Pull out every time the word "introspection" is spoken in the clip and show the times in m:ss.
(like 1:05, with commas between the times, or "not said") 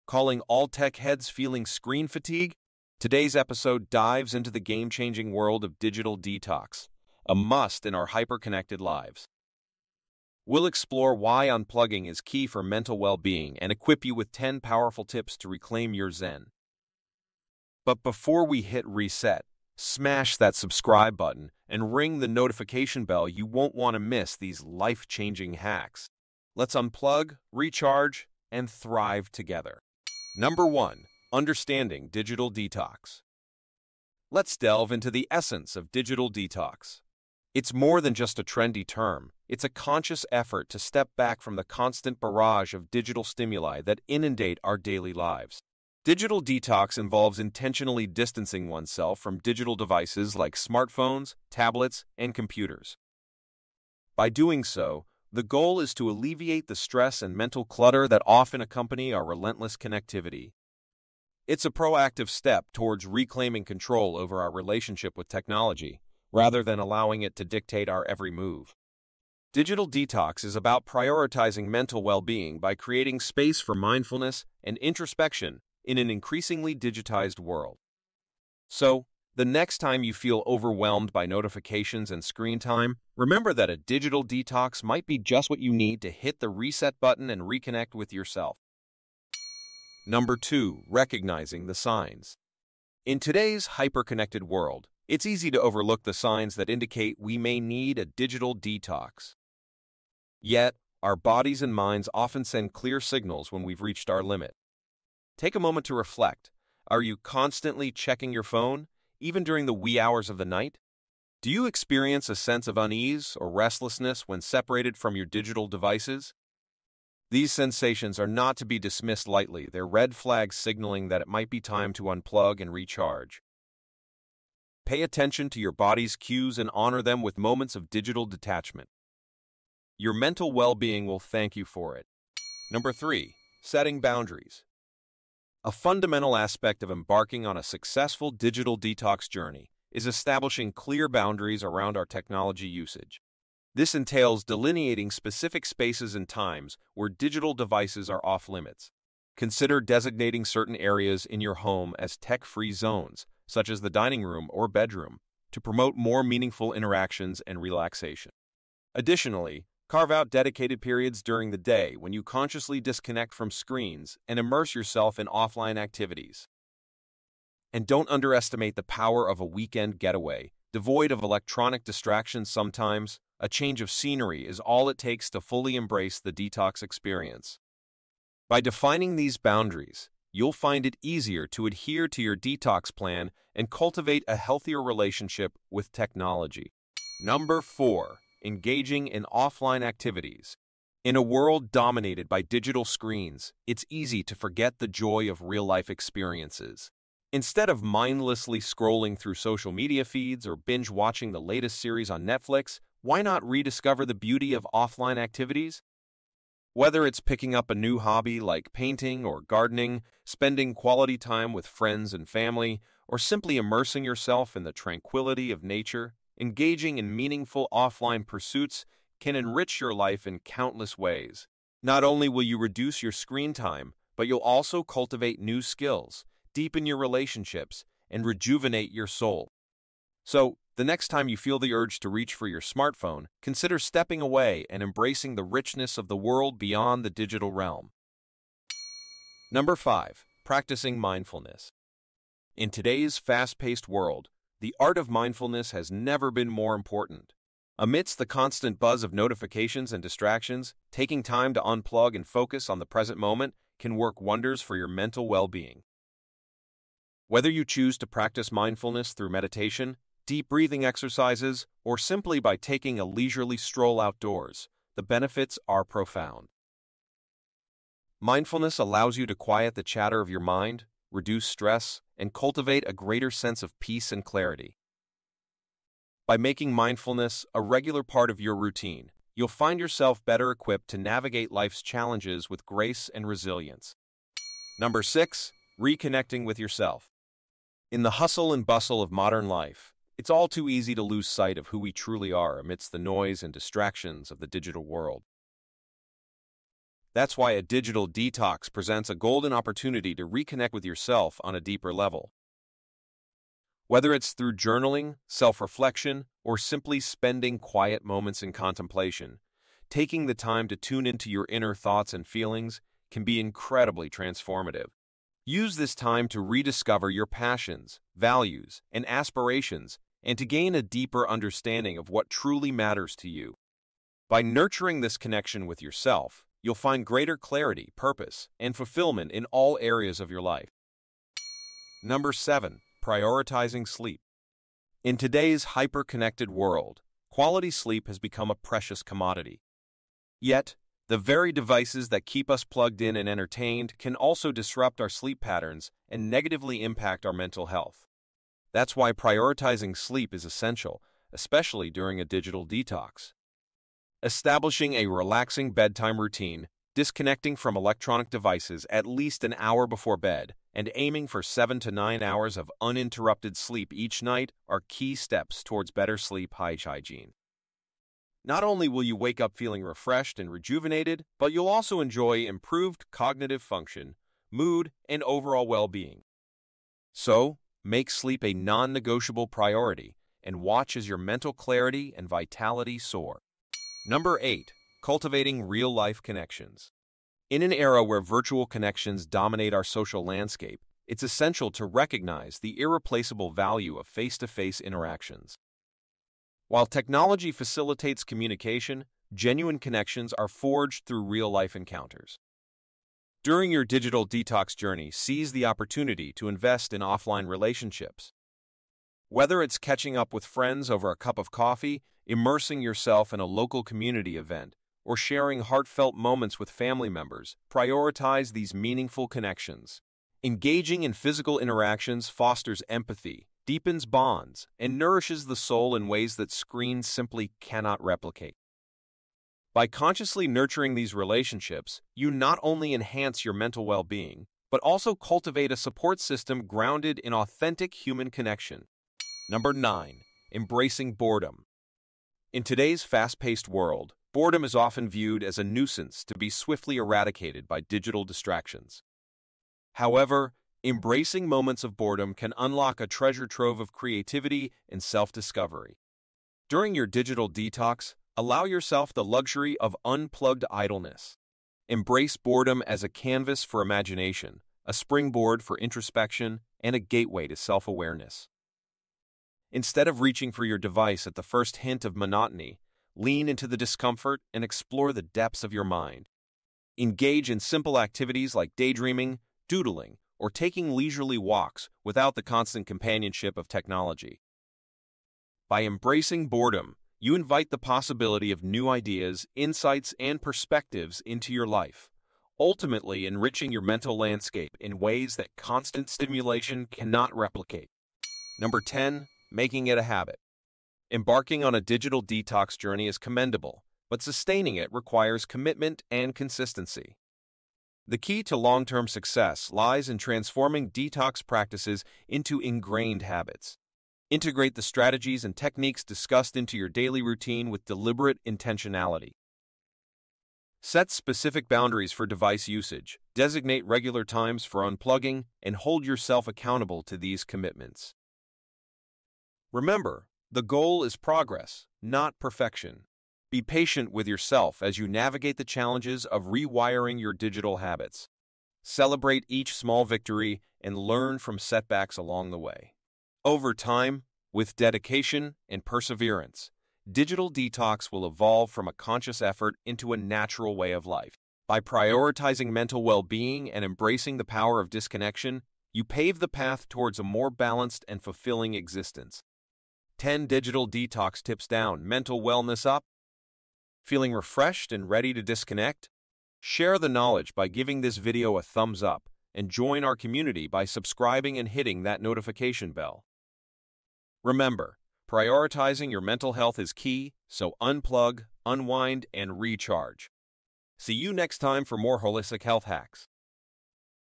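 1:14, 7:45.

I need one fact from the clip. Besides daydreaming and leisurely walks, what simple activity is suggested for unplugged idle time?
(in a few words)
doodling.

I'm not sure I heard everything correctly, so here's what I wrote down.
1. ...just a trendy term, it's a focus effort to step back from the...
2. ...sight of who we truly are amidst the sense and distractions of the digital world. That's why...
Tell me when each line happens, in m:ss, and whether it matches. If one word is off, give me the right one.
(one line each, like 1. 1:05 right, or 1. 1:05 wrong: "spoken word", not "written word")
1. 0:38 wrong: "conscious", not "focus"
2. 4:51 wrong: "noise", not "sense".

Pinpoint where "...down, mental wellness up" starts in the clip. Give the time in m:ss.
9:21.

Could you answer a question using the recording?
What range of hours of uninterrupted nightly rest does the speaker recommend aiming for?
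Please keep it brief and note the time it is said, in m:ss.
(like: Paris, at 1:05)
7 to 9 hours, at 6:01.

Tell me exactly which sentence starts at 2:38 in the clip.
Additionally, Carve out dedicated periods during the day when you consciously disconnect from screens and immerse yourself in offline activities.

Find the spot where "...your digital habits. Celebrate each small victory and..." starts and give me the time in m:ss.
8:57.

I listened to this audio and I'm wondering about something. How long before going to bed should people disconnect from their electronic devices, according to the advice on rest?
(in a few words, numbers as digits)
an hour.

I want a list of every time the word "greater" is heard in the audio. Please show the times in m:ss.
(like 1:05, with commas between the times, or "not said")
4:32, 5:27.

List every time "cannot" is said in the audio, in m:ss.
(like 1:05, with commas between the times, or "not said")
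7:07, 8:16.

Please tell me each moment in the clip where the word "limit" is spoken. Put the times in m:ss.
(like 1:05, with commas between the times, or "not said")
1:44, 2:28.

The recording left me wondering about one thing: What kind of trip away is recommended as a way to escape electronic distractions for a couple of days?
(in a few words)
weekend getaway.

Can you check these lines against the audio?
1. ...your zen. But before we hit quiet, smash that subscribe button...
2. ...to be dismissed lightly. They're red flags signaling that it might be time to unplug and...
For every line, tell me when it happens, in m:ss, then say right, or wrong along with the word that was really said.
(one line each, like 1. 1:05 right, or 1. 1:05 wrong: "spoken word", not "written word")
1. 0:15 wrong: "reset", not "quiet"
2. 1:58 right.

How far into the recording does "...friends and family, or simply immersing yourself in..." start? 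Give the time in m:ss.
3:31.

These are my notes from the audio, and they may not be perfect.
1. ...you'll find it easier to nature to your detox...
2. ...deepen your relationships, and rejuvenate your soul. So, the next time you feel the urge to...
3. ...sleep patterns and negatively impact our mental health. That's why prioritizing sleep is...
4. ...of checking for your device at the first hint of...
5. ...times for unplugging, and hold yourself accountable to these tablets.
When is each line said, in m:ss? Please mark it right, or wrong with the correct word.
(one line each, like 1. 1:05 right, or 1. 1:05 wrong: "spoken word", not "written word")
1. 3:00 wrong: "adhere", not "nature"
2. 3:46 right
3. 5:45 right
4. 7:50 wrong: "reaching", not "checking"
5. 8:44 wrong: "commitments", not "tablets".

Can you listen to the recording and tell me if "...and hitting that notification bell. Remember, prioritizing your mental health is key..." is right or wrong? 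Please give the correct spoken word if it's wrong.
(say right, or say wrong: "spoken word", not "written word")
right.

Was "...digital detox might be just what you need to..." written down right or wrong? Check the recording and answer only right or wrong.
right.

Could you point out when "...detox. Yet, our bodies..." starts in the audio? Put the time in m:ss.
1:38.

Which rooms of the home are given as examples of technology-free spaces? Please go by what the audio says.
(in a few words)
dining room or bedroom.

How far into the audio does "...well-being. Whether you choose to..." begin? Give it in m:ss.
4:15.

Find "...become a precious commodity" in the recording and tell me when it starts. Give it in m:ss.
5:38.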